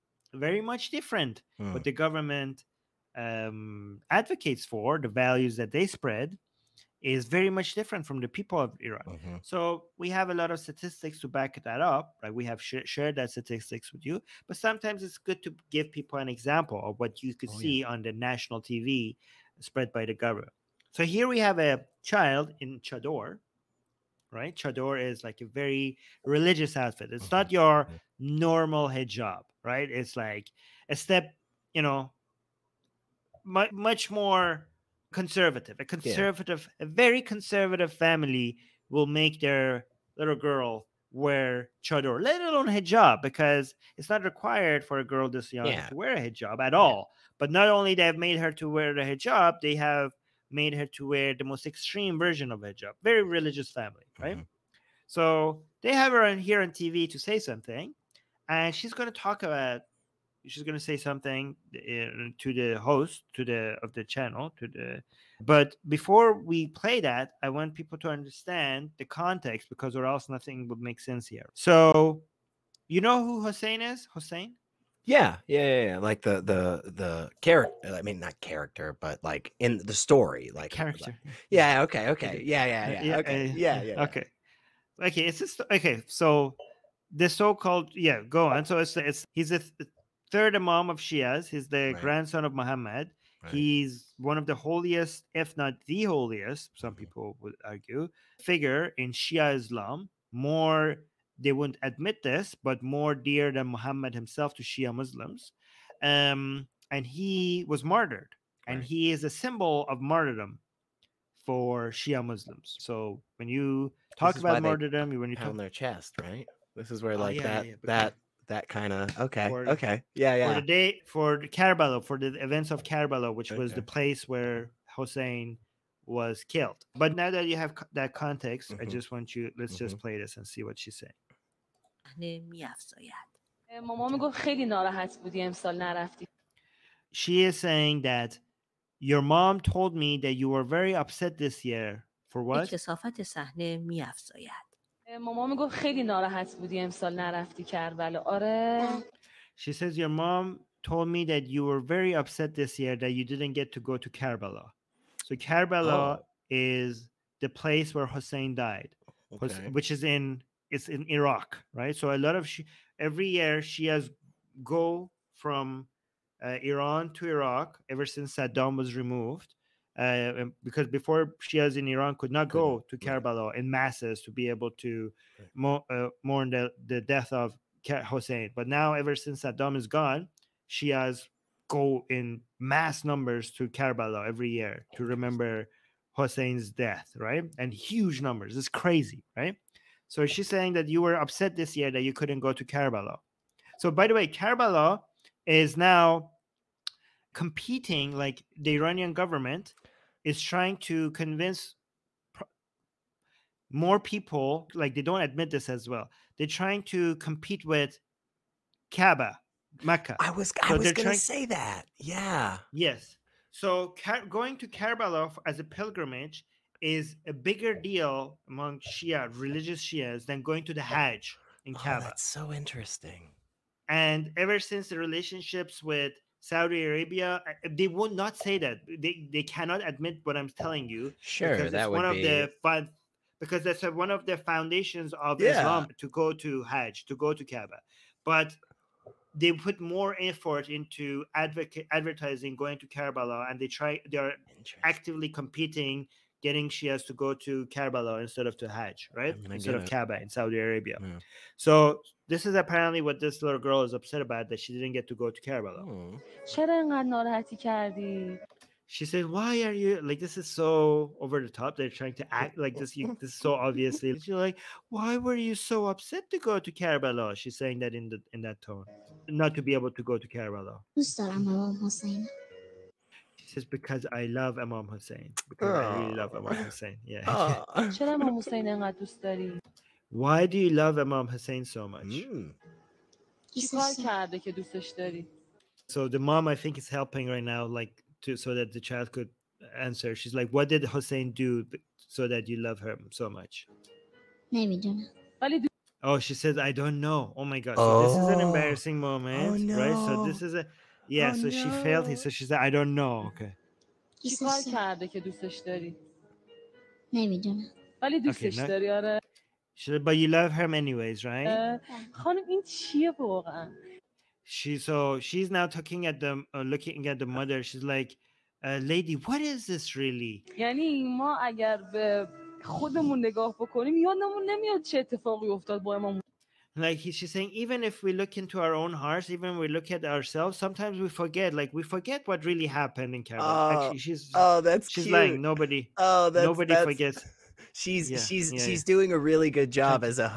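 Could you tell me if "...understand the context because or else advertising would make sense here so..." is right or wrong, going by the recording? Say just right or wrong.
wrong.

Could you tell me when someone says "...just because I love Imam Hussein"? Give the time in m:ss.
4:33.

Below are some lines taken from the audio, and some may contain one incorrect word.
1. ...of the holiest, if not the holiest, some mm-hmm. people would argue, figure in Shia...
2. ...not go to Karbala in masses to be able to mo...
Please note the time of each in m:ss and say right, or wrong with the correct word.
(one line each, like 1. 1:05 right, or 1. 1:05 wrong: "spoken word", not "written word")
1. 1:34 right
2. 2:52 right.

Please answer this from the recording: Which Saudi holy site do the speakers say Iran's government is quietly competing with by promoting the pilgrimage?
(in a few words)
Kaaba, Mecca.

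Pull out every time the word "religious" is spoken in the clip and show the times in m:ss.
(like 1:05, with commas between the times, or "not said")
0:26, 0:53, 3:39.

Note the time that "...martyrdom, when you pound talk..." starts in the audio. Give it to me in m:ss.
1:54.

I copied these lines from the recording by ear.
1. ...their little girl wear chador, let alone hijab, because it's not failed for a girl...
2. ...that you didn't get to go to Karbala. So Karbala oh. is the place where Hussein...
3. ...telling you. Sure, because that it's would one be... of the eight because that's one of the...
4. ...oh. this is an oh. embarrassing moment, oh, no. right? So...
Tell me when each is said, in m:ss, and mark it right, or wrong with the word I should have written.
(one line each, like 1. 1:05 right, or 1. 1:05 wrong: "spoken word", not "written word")
1. 0:39 wrong: "required", not "failed"
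2. 2:33 right
3. 3:50 wrong: "five", not "eight"
4. 4:57 right.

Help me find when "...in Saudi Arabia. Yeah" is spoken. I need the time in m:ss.
4:10.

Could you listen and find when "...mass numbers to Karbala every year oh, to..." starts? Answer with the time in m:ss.
3:02.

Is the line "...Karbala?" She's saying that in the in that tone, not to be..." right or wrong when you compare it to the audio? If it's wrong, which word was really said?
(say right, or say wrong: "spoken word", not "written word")
right.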